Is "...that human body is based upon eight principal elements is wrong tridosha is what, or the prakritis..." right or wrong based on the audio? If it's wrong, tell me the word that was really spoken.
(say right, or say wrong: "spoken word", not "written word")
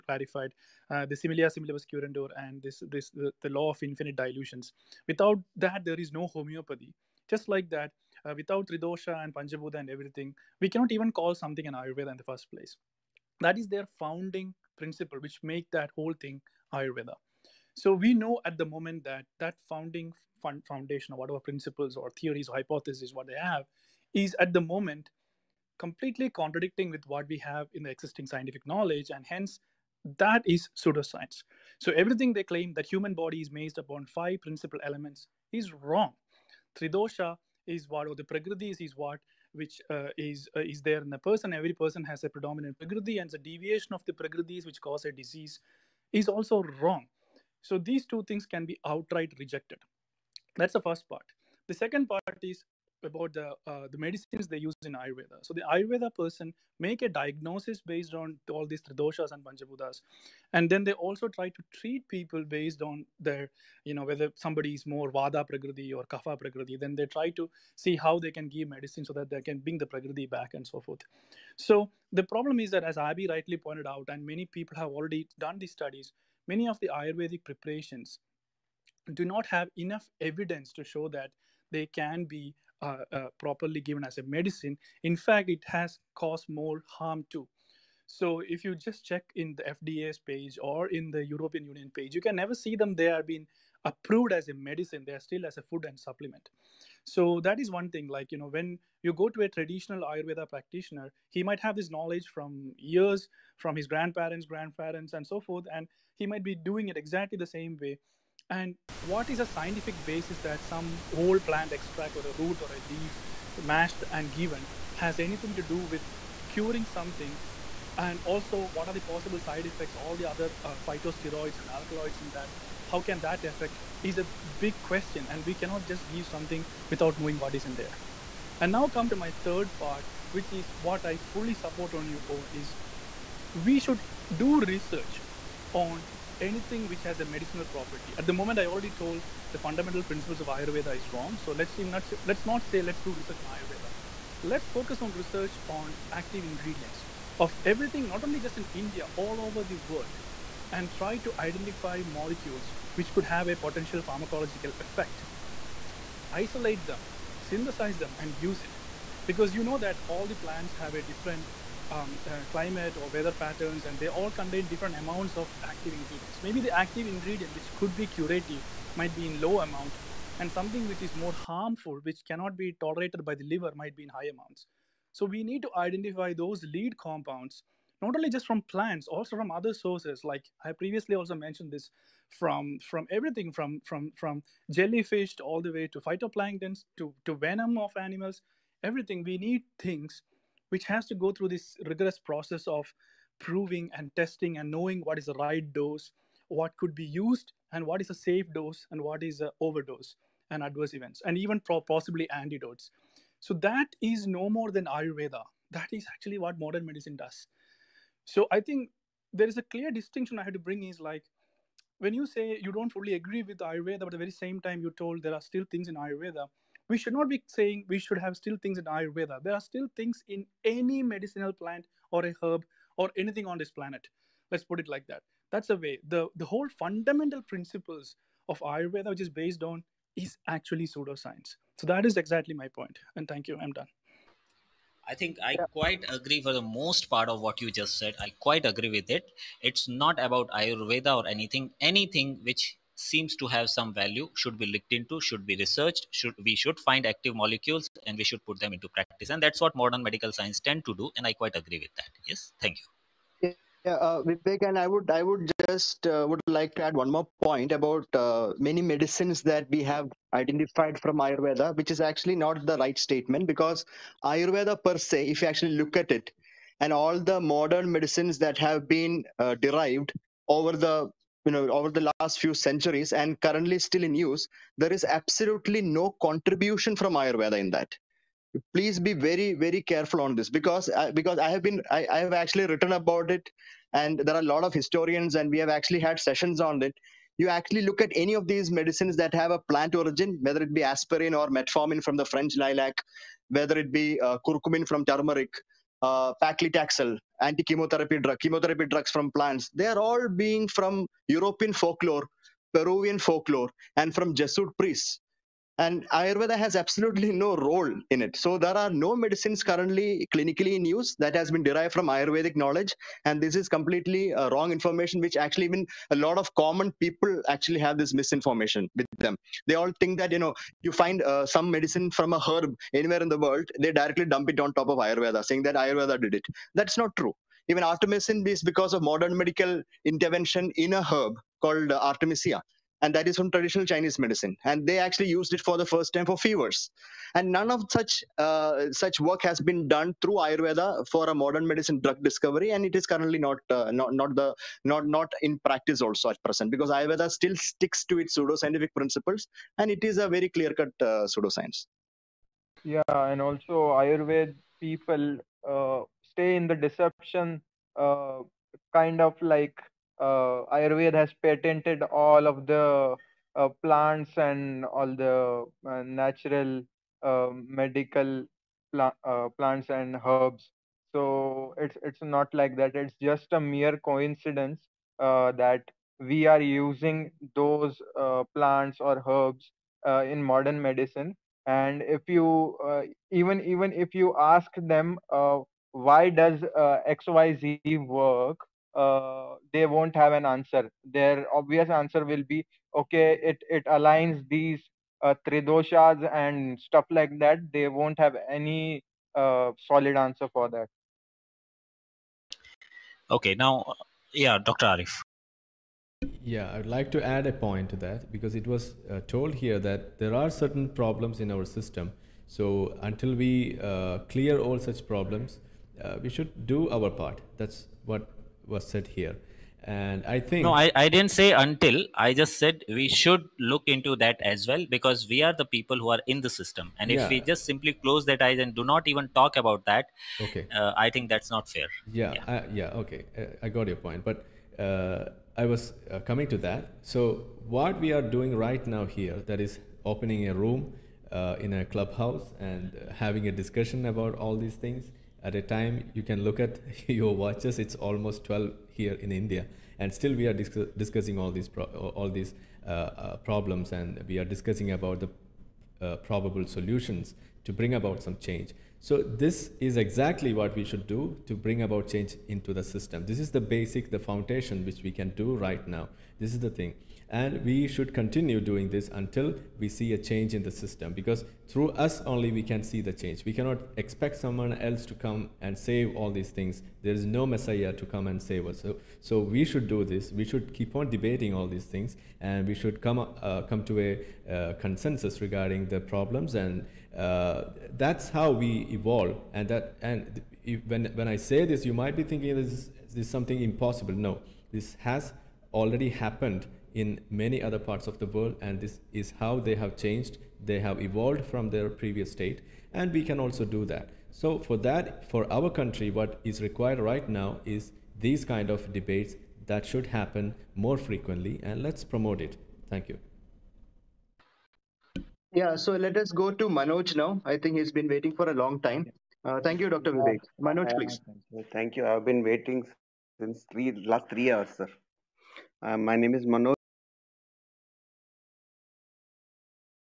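wrong: "five", not "eight".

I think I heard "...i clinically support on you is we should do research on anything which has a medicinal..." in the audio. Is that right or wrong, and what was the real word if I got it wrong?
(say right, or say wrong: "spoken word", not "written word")
wrong: "fully", not "clinically".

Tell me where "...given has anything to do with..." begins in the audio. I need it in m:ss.
1:54.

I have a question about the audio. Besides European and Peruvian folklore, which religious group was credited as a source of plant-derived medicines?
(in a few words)
Jesuit priests.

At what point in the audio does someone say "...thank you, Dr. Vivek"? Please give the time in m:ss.
8:39.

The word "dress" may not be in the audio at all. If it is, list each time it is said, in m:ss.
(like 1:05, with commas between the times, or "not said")
not said.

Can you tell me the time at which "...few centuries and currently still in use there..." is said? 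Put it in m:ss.
4:32.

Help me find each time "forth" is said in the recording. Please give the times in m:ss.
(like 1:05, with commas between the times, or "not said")
1:10, 1:45.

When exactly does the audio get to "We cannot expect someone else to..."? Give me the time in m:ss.
7:53.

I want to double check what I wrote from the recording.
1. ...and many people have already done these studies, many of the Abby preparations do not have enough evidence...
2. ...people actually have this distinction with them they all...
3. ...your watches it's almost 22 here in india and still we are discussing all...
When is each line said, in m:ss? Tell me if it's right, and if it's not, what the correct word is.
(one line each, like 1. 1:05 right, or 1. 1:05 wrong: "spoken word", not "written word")
1. 1:14 wrong: "Ayurvedic", not "Abby"
2. 5:16 wrong: "misinformation", not "distinction"
3. 7:27 wrong: "12", not "22".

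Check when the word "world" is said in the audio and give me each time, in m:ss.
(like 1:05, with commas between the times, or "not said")
2:29, 5:23, 8:18.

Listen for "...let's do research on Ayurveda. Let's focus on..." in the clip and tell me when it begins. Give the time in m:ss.
2:22.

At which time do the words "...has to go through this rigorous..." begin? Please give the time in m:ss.
3:10.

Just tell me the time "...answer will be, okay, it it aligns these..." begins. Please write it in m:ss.
6:31.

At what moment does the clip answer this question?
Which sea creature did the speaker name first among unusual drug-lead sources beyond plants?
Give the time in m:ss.
3:04.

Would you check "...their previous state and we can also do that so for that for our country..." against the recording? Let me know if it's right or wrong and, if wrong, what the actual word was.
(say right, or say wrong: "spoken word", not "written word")
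right.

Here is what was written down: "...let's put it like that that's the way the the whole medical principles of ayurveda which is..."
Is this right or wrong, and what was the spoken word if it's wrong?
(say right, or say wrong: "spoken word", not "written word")
wrong: "fundamental", not "medical".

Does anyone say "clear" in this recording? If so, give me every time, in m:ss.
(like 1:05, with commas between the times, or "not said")
3:29, 5:50, 6:54.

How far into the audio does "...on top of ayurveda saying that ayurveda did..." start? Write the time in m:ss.
5:24.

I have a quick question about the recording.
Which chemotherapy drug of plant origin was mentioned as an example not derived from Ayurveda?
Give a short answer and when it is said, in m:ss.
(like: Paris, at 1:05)
paclitaxel, at 4:56.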